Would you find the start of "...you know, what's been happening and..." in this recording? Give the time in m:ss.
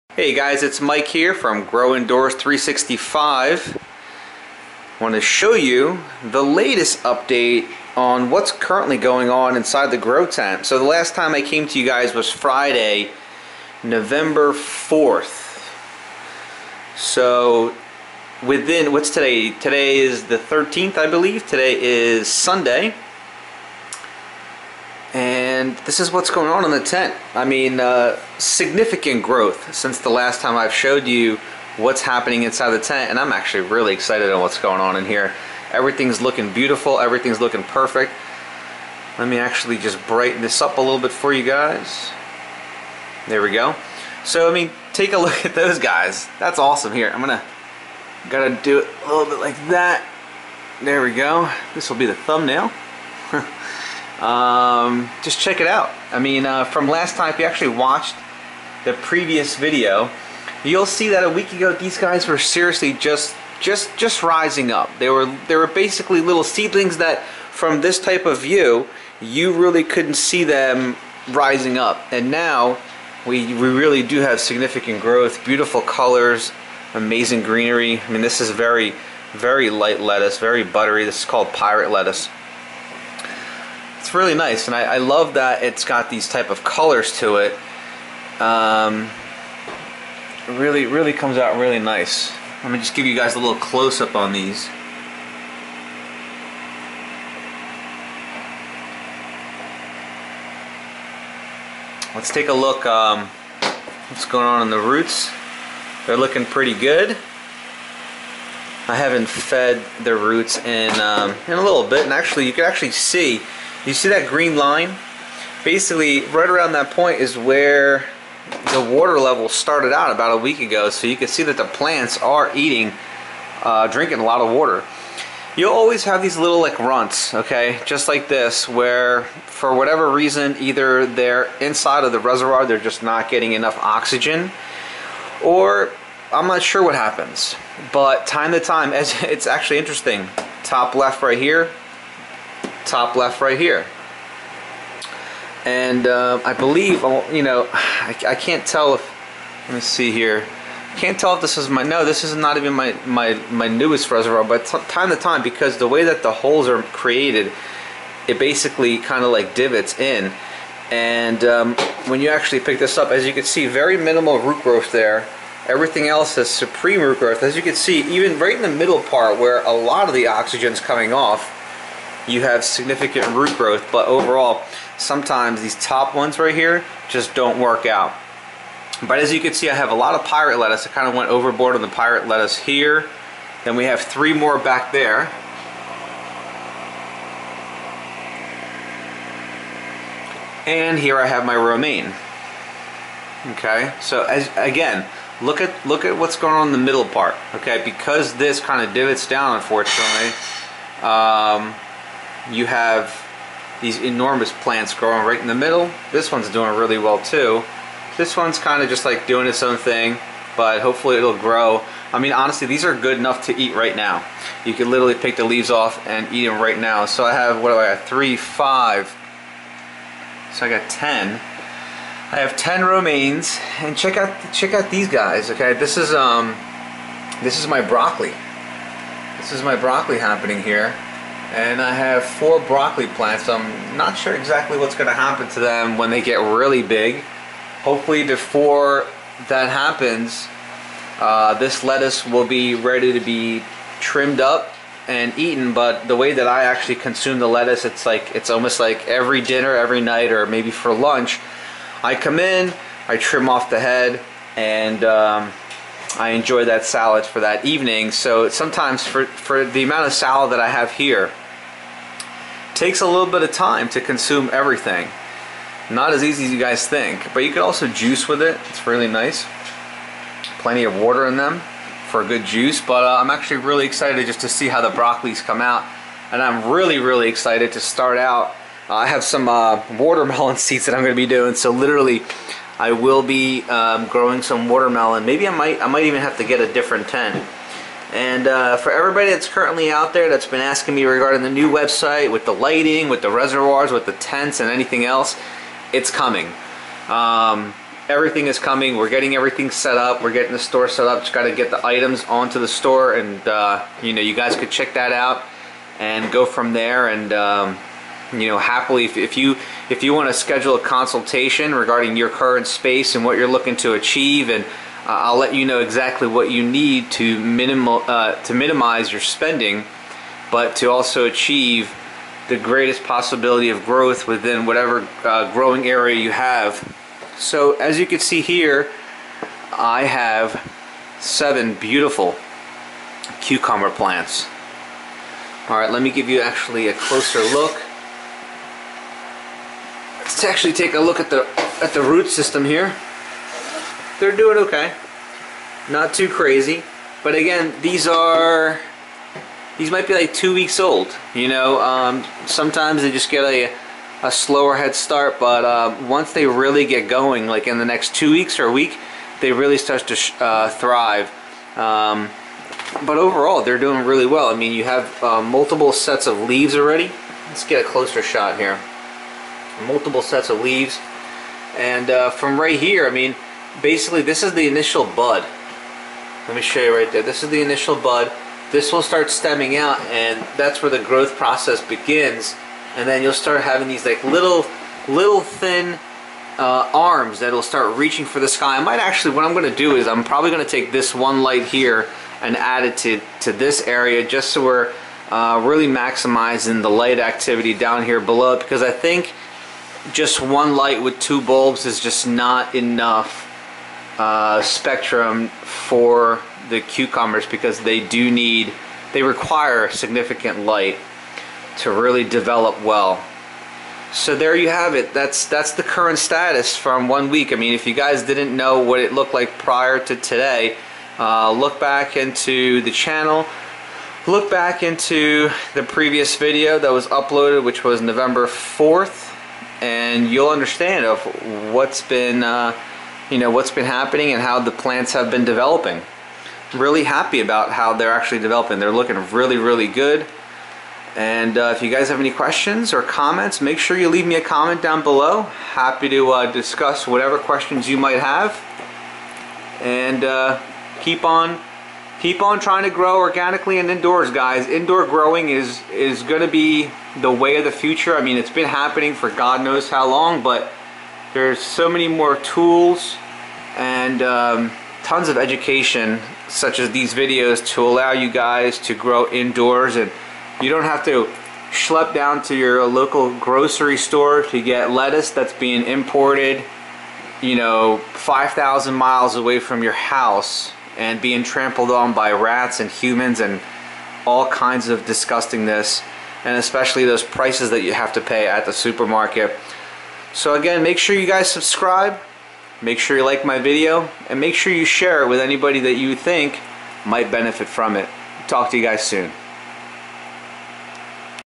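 7:13.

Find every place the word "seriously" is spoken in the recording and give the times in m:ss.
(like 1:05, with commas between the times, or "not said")
1:02.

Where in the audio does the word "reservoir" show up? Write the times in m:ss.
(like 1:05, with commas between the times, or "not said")
2:12, 2:34, 4:53.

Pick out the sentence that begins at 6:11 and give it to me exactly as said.
And uh, from right here, I mean, basically this is the initial bud.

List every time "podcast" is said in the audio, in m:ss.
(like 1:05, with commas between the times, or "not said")
not said.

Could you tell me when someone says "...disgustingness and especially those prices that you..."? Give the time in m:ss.
8:05.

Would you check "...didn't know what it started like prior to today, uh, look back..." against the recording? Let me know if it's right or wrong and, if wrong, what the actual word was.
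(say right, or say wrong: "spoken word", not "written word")
wrong: "looked", not "started".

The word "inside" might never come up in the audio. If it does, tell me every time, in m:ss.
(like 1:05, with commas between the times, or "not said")
0:09, 0:32, 2:11.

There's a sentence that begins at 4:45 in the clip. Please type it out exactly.
Maybe I might, I might even have to get a different tent.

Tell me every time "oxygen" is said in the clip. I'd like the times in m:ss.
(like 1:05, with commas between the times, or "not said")
2:13, 2:50.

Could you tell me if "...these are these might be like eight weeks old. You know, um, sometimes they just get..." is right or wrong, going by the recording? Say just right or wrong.
wrong.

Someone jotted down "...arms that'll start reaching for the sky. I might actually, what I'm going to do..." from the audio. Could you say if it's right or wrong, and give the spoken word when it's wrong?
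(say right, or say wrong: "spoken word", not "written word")
right.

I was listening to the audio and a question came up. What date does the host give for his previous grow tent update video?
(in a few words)
Friday, November 4th.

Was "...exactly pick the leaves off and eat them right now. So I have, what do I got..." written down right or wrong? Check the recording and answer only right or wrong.
wrong.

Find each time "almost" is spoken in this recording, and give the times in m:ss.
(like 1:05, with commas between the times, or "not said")
4:08.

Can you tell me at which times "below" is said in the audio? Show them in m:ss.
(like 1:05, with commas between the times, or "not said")
6:38, 7:25.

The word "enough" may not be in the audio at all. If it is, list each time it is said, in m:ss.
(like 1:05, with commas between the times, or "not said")
2:13, 3:33, 6:42.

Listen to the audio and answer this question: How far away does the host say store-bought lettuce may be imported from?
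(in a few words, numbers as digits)
5,000 miles.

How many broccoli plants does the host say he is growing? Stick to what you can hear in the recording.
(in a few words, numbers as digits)
4.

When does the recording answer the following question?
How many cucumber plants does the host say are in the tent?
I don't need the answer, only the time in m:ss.
5:31.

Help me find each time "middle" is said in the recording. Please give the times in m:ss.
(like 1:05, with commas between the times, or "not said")
2:48, 3:16, 3:25.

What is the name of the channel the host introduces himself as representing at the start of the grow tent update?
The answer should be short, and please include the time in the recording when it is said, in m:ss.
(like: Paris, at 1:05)
Grow Indoors 365, at 0:01.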